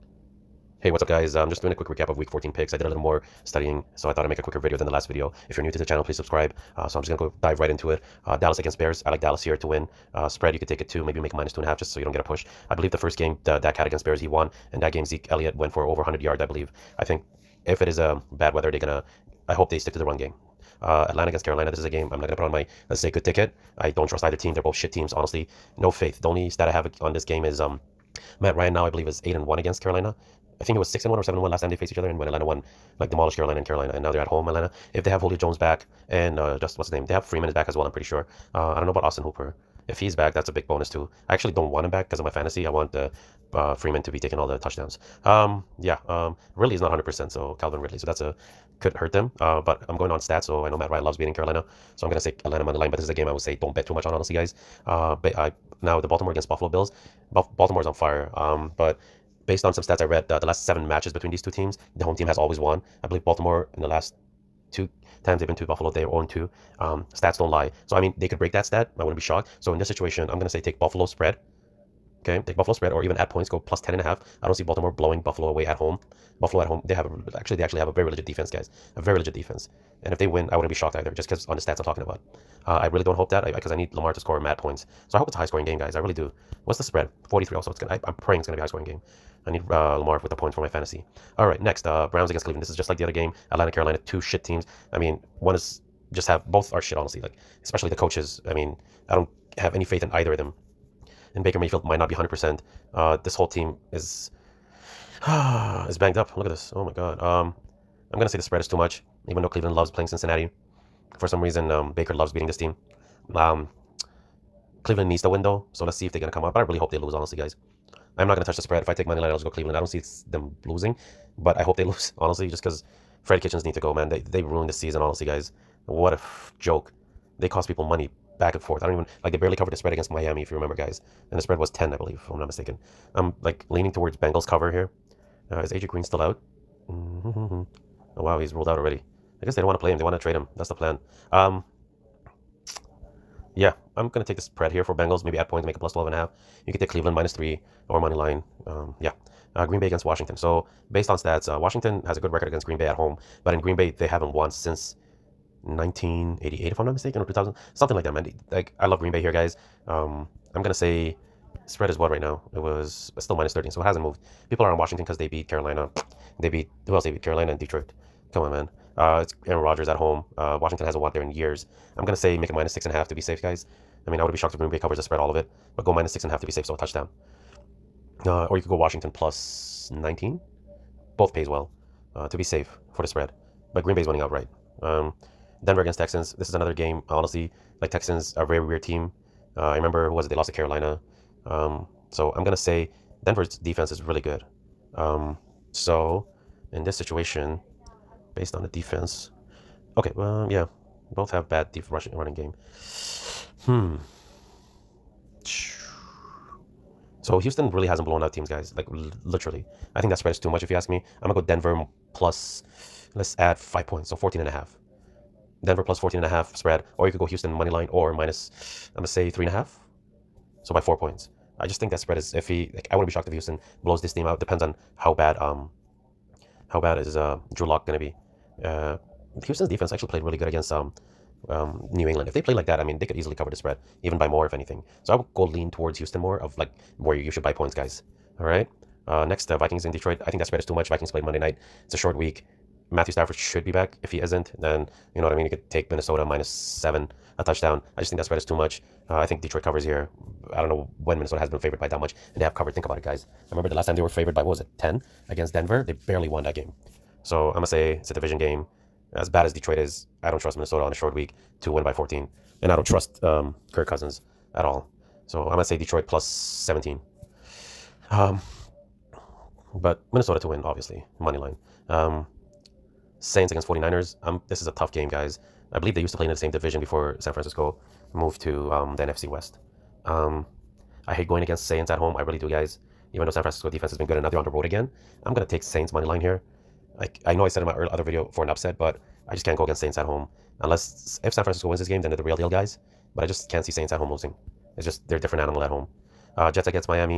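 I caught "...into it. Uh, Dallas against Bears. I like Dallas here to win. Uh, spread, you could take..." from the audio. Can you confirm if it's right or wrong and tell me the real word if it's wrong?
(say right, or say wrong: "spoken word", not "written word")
right.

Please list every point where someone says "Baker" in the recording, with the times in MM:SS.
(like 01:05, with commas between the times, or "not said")
01:41, 01:51.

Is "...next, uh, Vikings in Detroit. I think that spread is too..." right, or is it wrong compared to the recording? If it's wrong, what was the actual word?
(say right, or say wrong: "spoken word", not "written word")
right.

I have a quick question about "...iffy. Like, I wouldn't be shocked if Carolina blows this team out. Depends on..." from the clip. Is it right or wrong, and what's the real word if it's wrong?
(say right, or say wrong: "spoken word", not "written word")
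wrong: "Houston", not "Carolina".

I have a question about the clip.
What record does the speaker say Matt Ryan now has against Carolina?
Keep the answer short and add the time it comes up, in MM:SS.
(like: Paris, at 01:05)
8 and 1, at 00:29.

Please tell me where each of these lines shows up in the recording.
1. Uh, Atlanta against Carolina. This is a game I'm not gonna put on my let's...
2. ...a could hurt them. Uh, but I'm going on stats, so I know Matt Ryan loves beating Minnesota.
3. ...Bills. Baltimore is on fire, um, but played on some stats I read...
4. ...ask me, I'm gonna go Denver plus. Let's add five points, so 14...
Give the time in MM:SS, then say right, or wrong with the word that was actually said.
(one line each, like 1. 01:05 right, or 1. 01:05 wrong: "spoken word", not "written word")
1. 00:20 right
2. 00:48 wrong: "Carolina", not "Minnesota"
3. 00:56 wrong: "based", not "played"
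4. 03:30 right.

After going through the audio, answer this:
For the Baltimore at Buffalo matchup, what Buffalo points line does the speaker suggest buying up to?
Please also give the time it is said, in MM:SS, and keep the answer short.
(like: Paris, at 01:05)
plus 10 and a half, at 01:13.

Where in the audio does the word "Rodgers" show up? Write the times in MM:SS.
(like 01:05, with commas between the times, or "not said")
02:49.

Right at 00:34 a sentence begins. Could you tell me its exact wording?
If they have Julio Jones back and uh, just what's his name, they have Freeman is back as well.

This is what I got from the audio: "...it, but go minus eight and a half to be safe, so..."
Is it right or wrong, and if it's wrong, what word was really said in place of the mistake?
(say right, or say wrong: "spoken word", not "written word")
wrong: "six", not "eight".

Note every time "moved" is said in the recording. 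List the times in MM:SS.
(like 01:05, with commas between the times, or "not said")
02:44, 04:38.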